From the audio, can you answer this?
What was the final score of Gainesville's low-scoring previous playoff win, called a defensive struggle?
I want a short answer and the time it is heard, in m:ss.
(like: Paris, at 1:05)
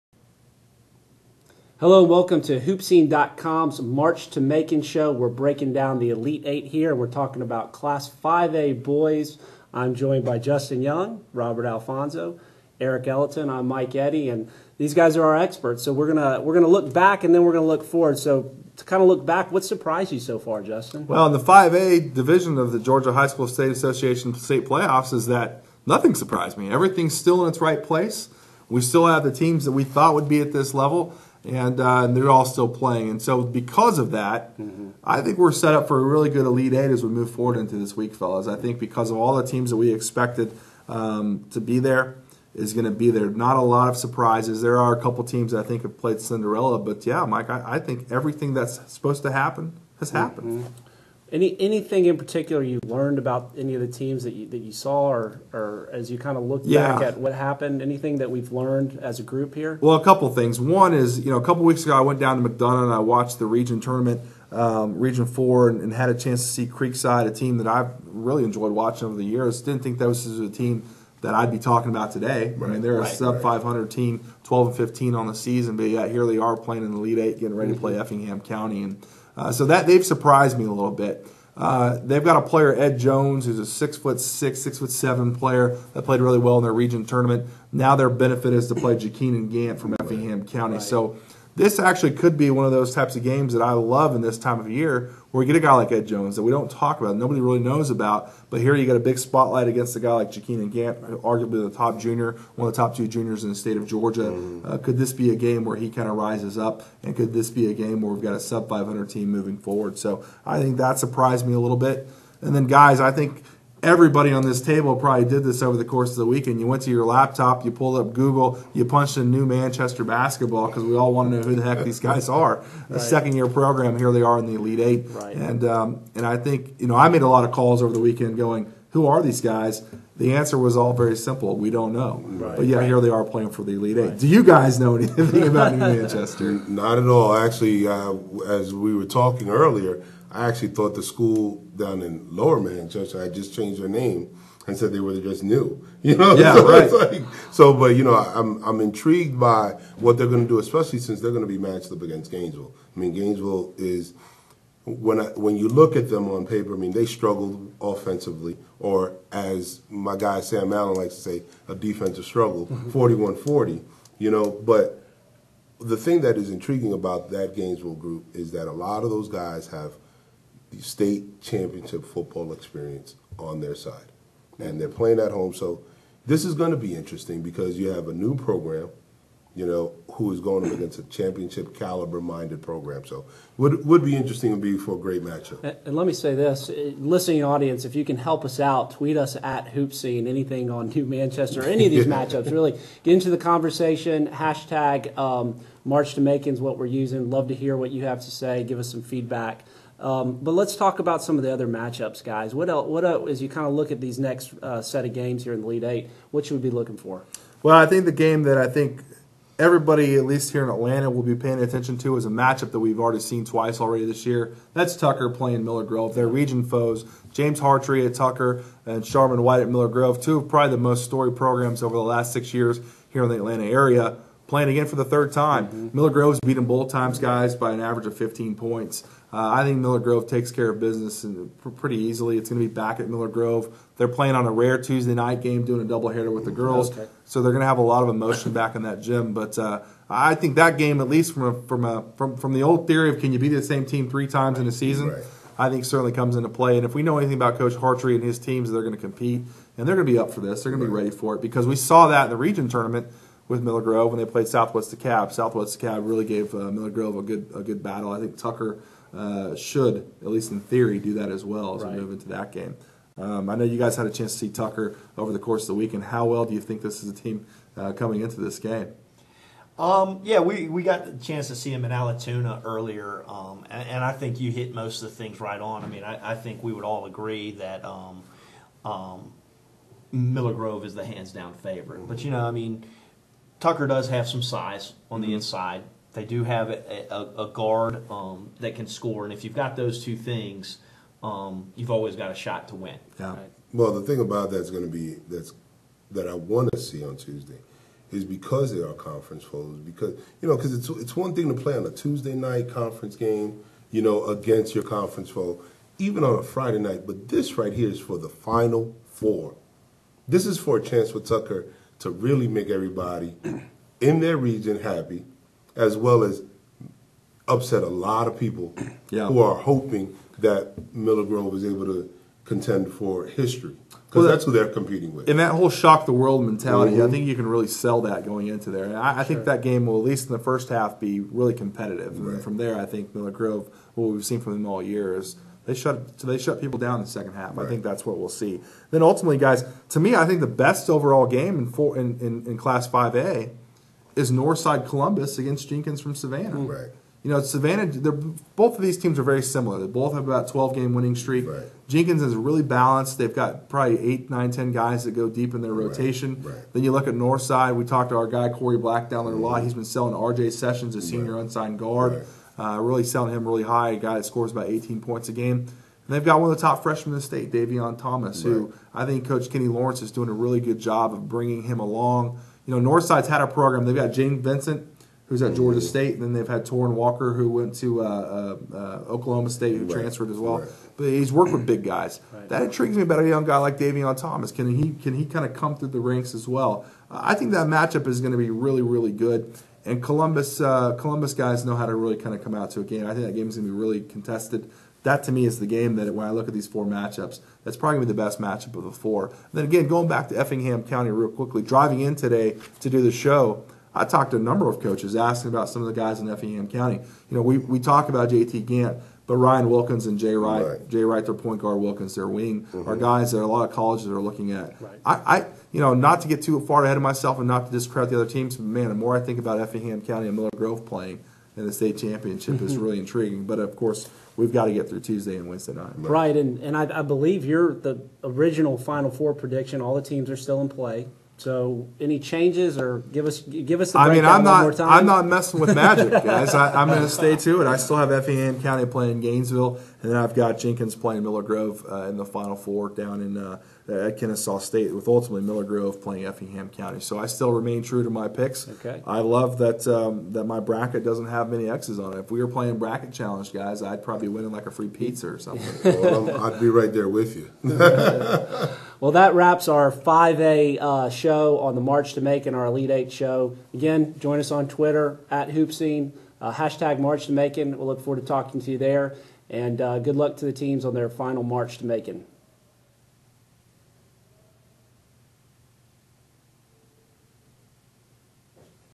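41-40, at 2:42.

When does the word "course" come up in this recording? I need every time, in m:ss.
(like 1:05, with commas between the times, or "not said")
1:55, 4:25, 7:03.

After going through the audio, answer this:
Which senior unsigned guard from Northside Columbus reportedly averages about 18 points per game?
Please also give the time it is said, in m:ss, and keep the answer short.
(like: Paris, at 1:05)
R.J. Sessions, at 6:00.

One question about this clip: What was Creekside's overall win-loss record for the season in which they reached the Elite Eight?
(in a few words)
12-15.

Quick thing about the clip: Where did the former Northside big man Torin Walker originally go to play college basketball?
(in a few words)
Oklahoma State.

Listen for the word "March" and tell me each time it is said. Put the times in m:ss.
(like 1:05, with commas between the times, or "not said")
0:03, 3:15, 7:41, 7:46, 7:51.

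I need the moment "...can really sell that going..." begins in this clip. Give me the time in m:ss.
5:27.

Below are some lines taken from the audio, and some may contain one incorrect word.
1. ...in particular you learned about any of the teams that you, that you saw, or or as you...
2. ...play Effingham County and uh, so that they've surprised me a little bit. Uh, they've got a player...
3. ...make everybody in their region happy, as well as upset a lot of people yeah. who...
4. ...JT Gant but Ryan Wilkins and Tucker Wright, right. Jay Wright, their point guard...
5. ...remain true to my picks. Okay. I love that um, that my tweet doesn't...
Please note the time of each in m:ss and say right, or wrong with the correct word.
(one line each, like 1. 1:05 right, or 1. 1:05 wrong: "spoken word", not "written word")
1. 0:52 right
2. 1:17 right
3. 5:12 right
4. 6:48 wrong: "Jay", not "Tucker"
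5. 7:27 wrong: "bracket", not "tweet".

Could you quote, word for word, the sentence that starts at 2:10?
The answer was all very simple.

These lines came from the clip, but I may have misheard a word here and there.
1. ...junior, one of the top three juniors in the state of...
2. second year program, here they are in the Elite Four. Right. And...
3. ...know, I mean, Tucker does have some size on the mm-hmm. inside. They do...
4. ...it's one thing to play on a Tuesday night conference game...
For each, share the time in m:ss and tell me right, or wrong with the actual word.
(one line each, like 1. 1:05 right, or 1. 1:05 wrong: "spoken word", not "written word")
1. 1:41 wrong: "two", not "three"
2. 2:03 wrong: "Eight", not "Four"
3. 4:42 right
4. 5:00 right.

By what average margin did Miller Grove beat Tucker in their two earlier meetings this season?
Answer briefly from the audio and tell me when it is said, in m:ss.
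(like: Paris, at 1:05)
15 points, at 3:48.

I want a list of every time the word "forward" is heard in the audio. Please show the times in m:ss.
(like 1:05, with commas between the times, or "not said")
0:17, 0:37, 1:49, 7:47.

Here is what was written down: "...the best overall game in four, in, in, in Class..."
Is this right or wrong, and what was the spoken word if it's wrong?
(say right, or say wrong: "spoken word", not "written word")
right.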